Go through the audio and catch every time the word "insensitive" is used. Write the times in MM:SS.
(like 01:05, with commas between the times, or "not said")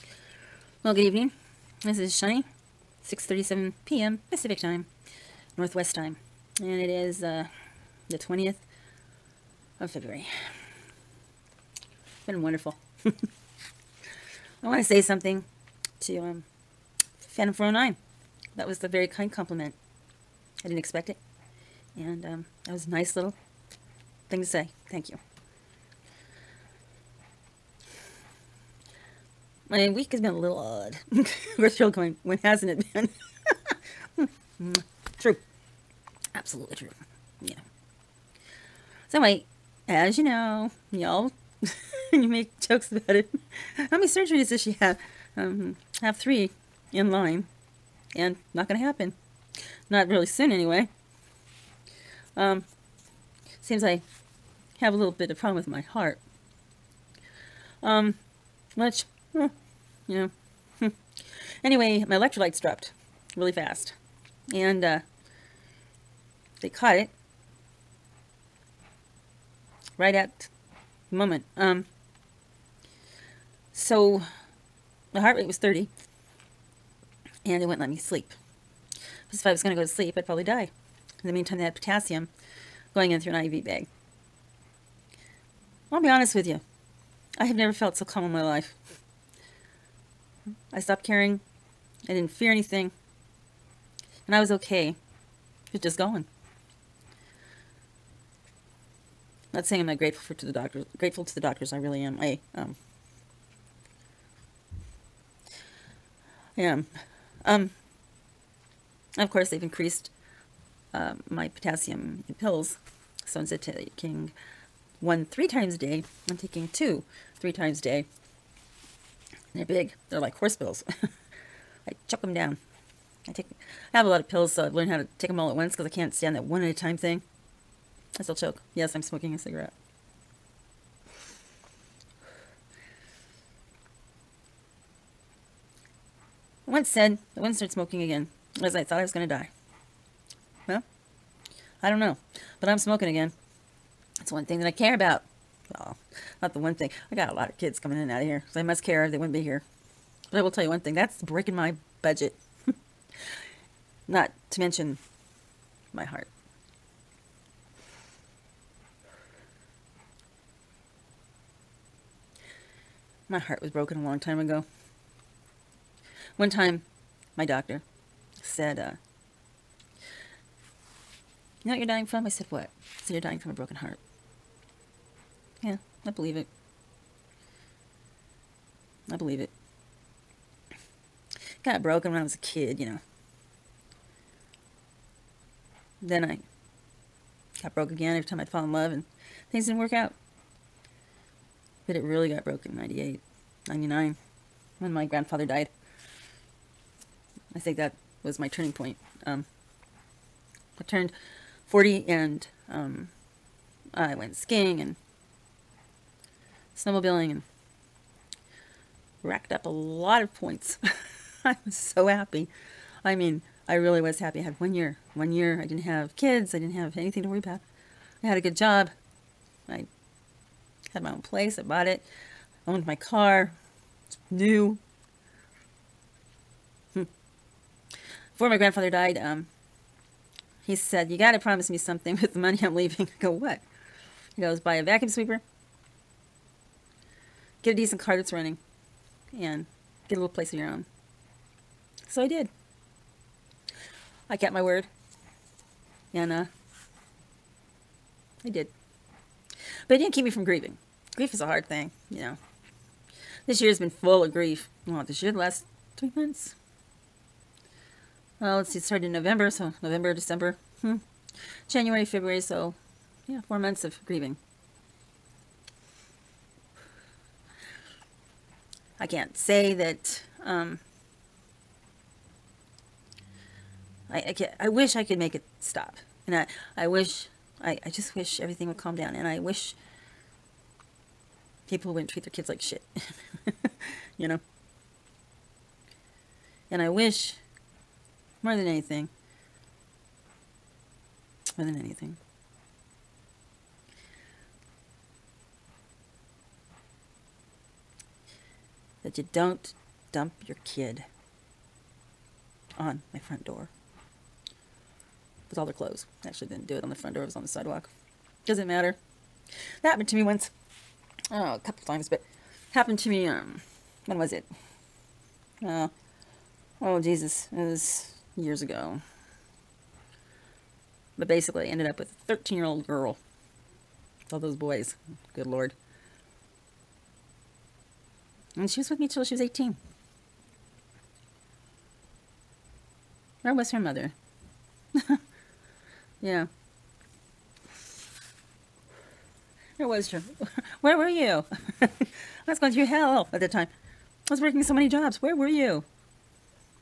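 not said.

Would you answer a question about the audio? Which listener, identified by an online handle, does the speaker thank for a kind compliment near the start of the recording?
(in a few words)
Phantom 409.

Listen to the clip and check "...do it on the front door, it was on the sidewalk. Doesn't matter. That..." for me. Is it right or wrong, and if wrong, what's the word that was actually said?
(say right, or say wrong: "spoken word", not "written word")
right.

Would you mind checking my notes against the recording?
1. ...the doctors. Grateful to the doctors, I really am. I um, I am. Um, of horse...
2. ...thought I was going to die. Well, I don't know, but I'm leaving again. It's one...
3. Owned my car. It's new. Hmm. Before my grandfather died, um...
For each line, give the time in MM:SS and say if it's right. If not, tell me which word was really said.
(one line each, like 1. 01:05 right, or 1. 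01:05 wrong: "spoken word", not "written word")
1. 01:40 wrong: "course", not "horse"
2. 02:18 wrong: "smoking", not "leaving"
3. 03:42 right.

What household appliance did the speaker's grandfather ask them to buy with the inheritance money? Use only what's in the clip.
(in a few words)
vacuum sweeper.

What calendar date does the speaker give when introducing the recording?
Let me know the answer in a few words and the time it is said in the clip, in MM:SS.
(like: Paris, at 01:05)
February 20, at 00:08.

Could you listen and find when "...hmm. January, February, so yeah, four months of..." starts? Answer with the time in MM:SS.
04:20.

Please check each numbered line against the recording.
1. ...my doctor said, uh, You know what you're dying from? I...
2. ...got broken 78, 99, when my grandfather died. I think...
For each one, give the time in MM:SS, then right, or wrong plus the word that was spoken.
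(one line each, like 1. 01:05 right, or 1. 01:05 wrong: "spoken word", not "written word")
1. 02:47 right
2. 03:12 wrong: "98", not "78".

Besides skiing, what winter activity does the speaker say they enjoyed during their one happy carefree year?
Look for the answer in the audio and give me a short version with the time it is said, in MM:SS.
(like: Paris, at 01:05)
snowmobiling, at 03:26.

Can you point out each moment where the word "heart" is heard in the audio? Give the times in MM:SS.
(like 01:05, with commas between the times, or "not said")
00:55, 01:15, 02:36, 02:43, 02:53.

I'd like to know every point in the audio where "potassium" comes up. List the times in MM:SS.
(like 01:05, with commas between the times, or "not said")
01:21, 01:51.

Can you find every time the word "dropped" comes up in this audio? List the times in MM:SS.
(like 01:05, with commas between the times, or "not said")
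01:02.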